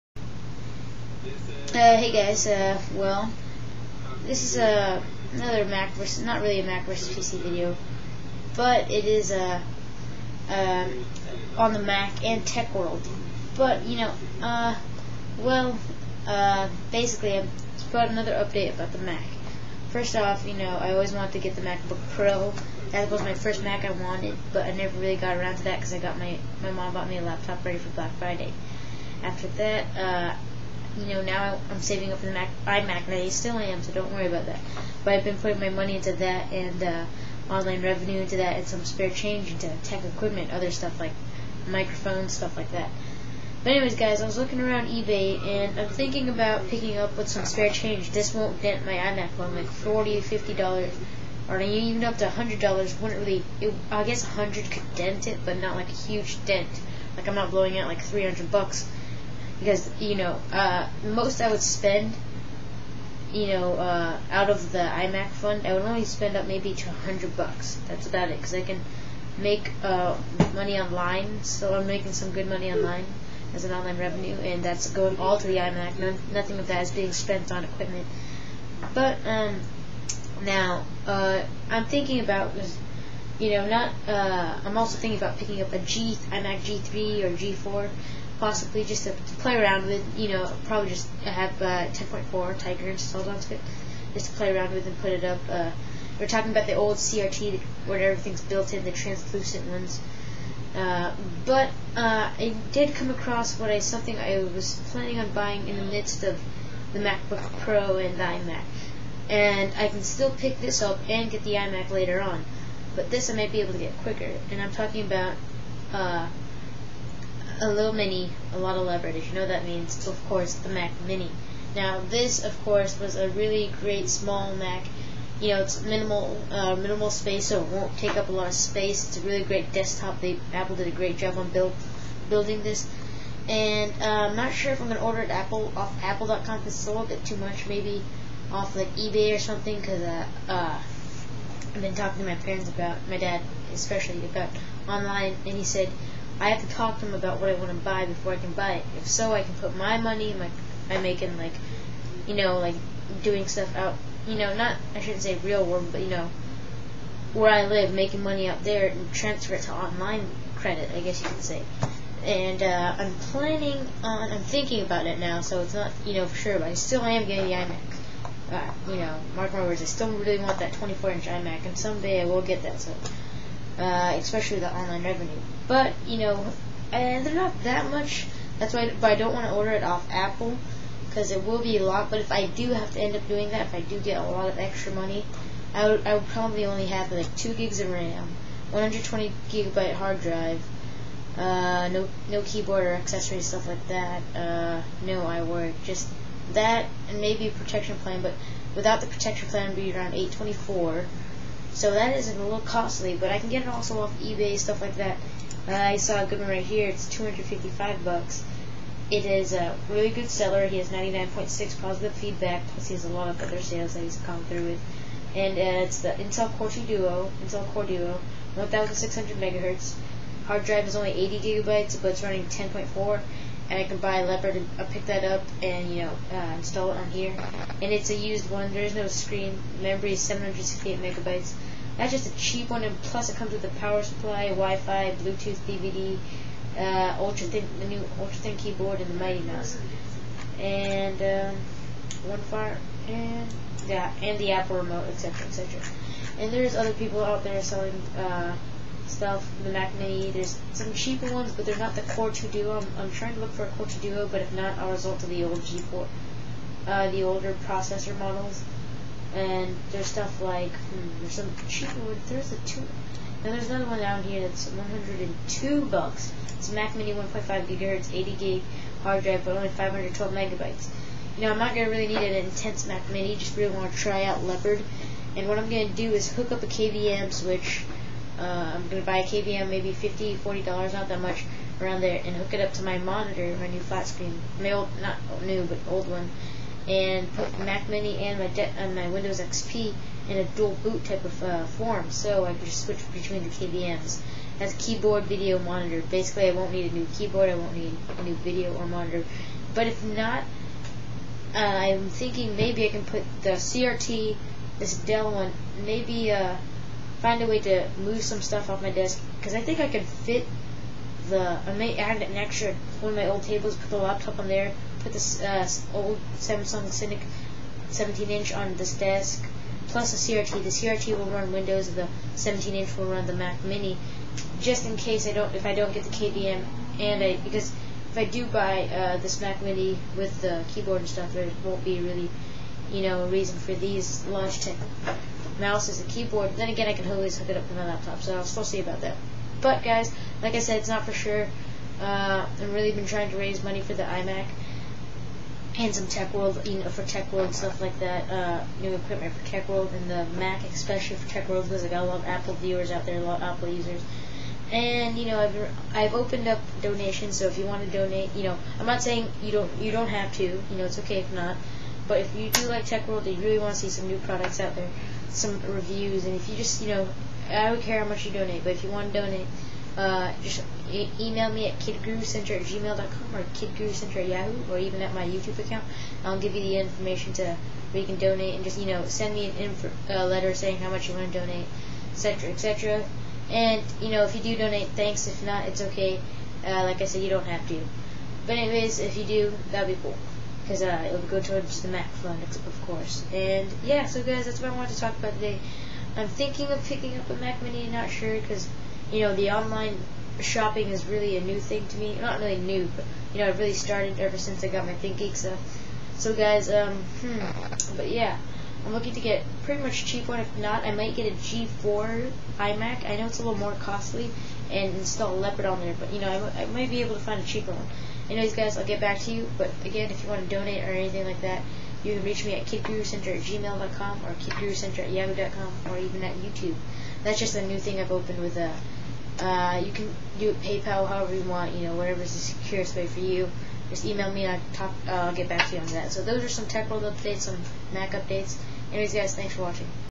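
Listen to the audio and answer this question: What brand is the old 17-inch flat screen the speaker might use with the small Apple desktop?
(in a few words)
Samsung.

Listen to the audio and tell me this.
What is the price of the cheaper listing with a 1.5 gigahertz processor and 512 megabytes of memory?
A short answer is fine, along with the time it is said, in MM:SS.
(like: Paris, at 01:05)
$102, at 04:24.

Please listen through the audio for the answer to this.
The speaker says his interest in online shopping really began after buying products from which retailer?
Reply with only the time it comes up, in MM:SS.
06:44.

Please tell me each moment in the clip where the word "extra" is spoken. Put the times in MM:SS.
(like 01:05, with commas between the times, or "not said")
03:04, 05:12.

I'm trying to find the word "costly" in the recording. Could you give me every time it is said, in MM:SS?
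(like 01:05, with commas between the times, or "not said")
03:22, 06:53.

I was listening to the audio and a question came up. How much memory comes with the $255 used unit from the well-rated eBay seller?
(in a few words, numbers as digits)
768 megabytes.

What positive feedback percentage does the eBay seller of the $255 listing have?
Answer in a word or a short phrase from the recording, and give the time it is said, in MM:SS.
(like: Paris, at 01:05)
99.6, at 03:30.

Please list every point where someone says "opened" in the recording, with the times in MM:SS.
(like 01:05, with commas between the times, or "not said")
05:56, 07:08.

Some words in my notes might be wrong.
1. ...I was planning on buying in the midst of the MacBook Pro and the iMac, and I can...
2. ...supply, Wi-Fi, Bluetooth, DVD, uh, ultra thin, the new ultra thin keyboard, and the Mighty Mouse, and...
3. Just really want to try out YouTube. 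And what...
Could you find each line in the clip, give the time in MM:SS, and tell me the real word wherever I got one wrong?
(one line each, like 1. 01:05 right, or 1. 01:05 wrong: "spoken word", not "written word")
1. 01:44 right
2. 03:54 right
3. 04:33 wrong: "Leopard", not "YouTube".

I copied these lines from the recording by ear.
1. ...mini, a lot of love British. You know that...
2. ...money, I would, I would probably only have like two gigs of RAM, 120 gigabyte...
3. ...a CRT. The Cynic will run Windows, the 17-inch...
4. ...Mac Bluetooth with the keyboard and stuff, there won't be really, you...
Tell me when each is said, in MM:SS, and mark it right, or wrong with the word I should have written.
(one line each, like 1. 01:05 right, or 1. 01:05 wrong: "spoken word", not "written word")
1. 01:57 right
2. 03:04 right
3. 05:20 wrong: "CRT", not "Cynic"
4. 05:29 wrong: "Mini", not "Bluetooth".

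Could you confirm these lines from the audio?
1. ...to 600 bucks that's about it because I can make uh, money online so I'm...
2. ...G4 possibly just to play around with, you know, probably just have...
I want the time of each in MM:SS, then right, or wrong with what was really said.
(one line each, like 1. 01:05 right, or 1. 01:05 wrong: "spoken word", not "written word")
1. 01:06 wrong: "100", not "600"
2. 01:27 right.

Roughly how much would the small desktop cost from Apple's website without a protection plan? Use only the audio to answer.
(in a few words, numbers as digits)
824.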